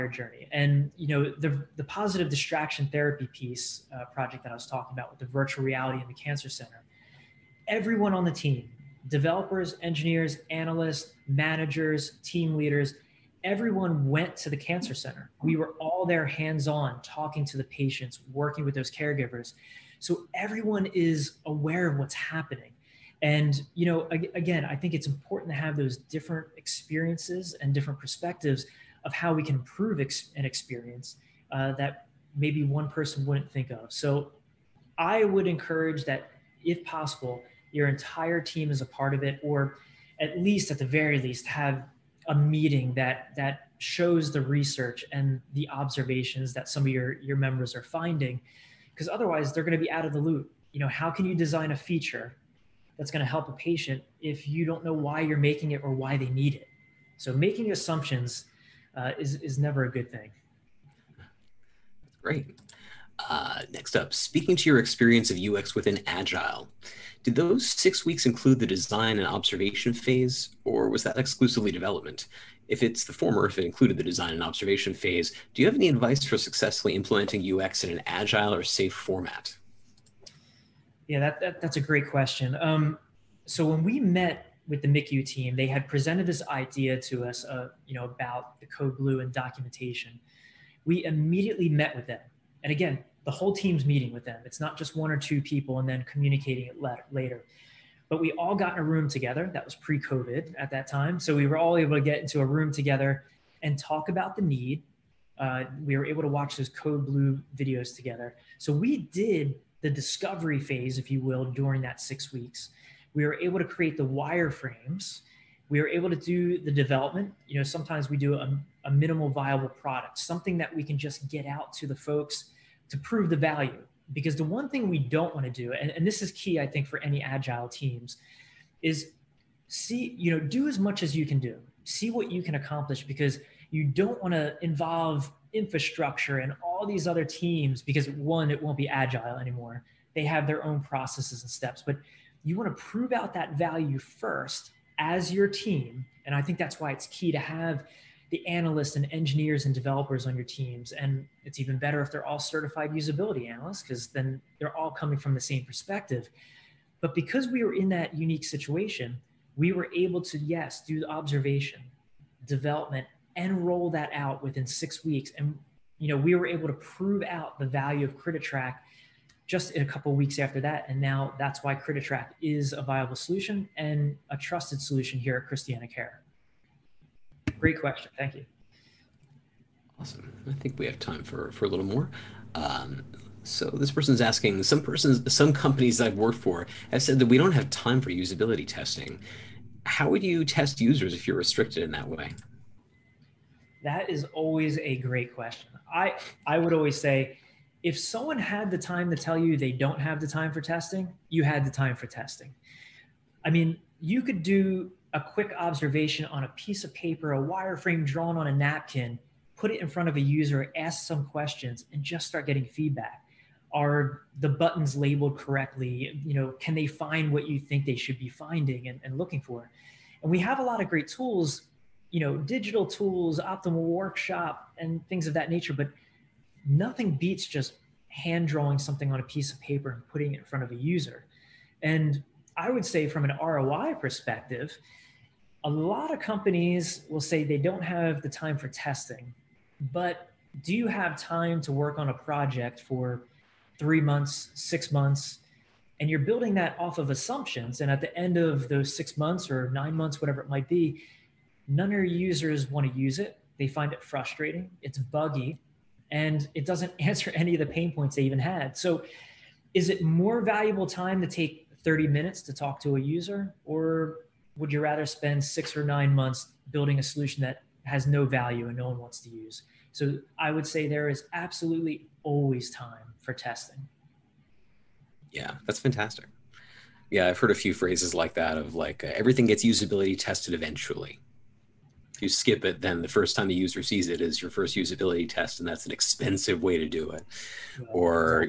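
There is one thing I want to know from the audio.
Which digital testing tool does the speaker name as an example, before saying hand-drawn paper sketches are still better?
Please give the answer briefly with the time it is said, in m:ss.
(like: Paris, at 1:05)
Optimal Workshop, at 3:43.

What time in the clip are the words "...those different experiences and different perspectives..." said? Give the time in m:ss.
0:25.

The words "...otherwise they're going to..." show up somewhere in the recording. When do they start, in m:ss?
0:49.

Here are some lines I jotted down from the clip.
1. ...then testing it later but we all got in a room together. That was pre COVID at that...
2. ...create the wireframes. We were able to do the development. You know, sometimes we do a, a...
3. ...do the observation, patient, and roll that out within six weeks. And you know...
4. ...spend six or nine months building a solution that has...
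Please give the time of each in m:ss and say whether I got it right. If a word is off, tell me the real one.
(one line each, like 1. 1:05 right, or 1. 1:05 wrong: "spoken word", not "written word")
1. 1:35 wrong: "communicating", not "testing"
2. 1:53 right
3. 2:40 wrong: "development", not "patient"
4. 4:25 right.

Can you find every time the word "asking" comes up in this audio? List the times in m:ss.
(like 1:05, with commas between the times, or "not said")
3:04.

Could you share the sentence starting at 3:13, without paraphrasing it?
That is always a great question.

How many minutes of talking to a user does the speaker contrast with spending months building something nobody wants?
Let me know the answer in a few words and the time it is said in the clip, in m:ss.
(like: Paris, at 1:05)
30, at 4:21.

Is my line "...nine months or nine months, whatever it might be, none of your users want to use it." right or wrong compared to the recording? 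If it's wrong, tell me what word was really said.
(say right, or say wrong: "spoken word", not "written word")
wrong: "six", not "nine".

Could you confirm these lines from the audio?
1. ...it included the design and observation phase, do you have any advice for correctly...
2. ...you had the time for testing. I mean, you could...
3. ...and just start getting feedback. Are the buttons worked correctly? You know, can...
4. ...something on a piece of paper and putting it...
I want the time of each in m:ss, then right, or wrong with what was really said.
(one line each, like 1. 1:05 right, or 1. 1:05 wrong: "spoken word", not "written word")
1. 1:13 wrong: "successfully", not "correctly"
2. 3:21 right
3. 3:31 wrong: "labeled", not "worked"
4. 3:48 right.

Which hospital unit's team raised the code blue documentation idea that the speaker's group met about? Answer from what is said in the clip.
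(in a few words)
MICU.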